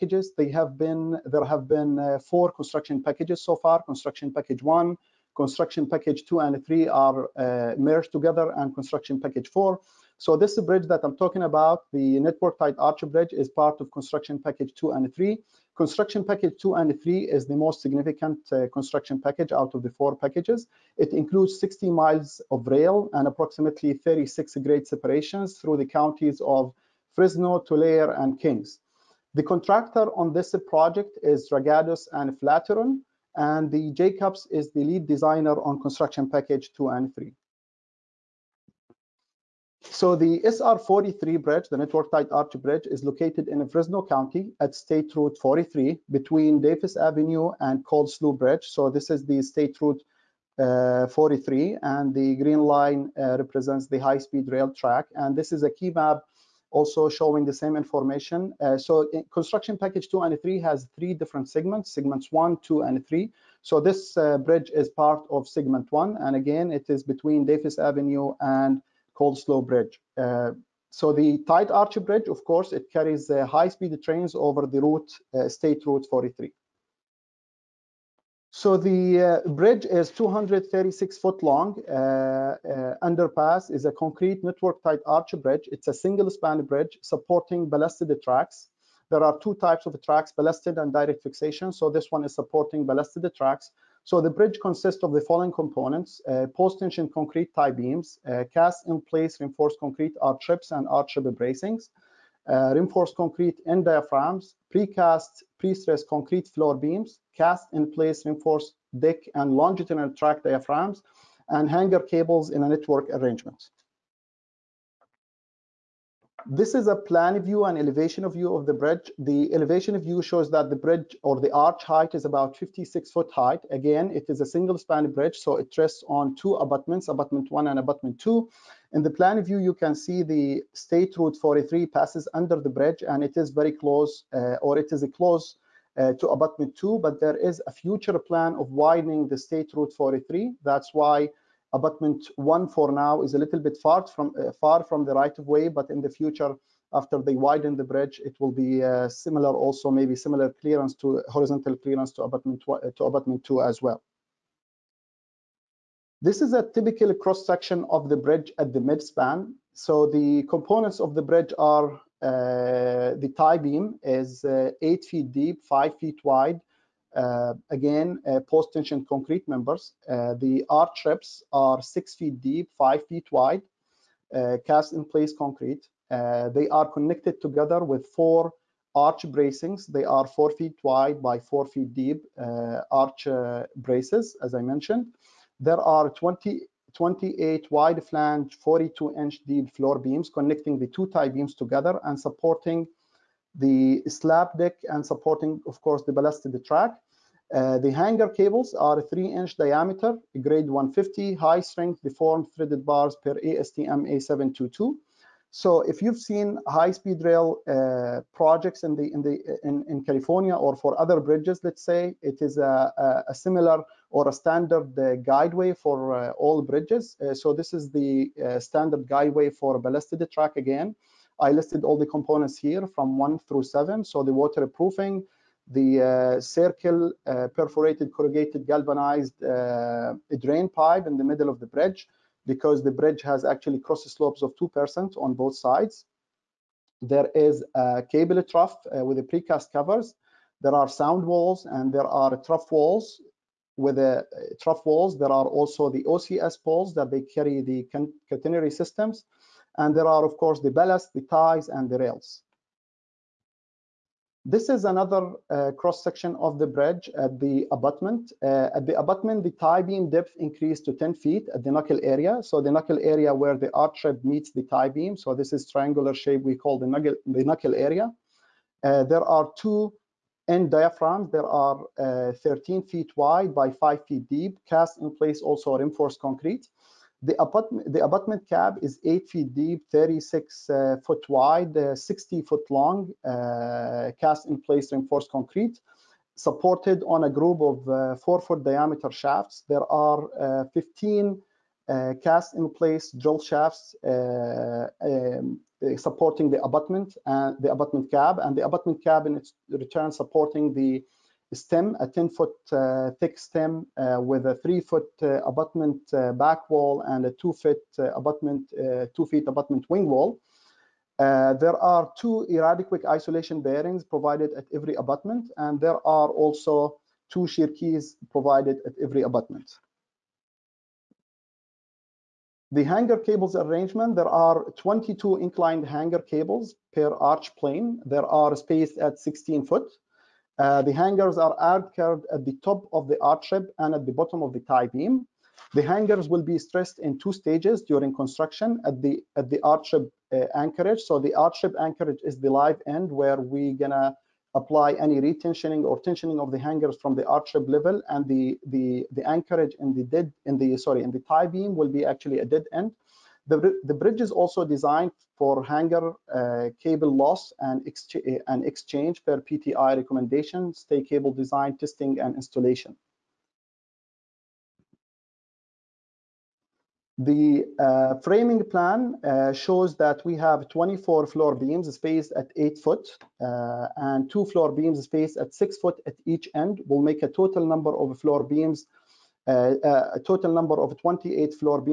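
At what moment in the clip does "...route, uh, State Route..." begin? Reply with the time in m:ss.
1:14.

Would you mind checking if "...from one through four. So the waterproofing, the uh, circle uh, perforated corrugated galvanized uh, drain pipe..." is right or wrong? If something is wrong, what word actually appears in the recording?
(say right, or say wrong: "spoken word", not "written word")
wrong: "seven", not "four".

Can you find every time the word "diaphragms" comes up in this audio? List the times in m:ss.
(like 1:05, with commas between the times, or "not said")
1:43, 1:50, 4:30.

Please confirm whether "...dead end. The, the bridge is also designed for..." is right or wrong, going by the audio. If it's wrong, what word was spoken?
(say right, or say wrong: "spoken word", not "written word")
right.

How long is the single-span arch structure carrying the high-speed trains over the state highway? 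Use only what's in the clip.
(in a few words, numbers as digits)
236 feet.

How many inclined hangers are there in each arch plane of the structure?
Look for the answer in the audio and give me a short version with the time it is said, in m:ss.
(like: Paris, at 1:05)
22, at 5:24.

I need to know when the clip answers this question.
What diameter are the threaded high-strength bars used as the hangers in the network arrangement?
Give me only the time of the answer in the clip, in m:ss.
3:19.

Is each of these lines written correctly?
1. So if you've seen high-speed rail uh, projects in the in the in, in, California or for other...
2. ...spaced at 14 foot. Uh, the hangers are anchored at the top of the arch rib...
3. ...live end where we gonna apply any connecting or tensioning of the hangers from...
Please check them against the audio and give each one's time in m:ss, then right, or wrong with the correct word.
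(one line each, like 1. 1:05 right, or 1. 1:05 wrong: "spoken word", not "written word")
1. 3:25 right
2. 5:28 wrong: "16", not "14"
3. 5:42 wrong: "retensioning", not "connecting".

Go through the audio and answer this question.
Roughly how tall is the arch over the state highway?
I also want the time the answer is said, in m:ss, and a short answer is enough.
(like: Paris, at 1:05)
56 feet, at 2:02.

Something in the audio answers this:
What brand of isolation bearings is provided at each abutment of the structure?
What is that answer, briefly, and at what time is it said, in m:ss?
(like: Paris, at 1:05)
EradiQuake, at 5:12.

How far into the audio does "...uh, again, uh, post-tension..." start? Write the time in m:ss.
2:47.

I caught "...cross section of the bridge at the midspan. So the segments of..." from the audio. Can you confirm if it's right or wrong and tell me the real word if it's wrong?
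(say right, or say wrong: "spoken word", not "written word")
wrong: "components", not "segments".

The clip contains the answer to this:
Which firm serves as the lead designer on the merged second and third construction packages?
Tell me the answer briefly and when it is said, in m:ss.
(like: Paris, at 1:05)
Jacobs, at 0:33.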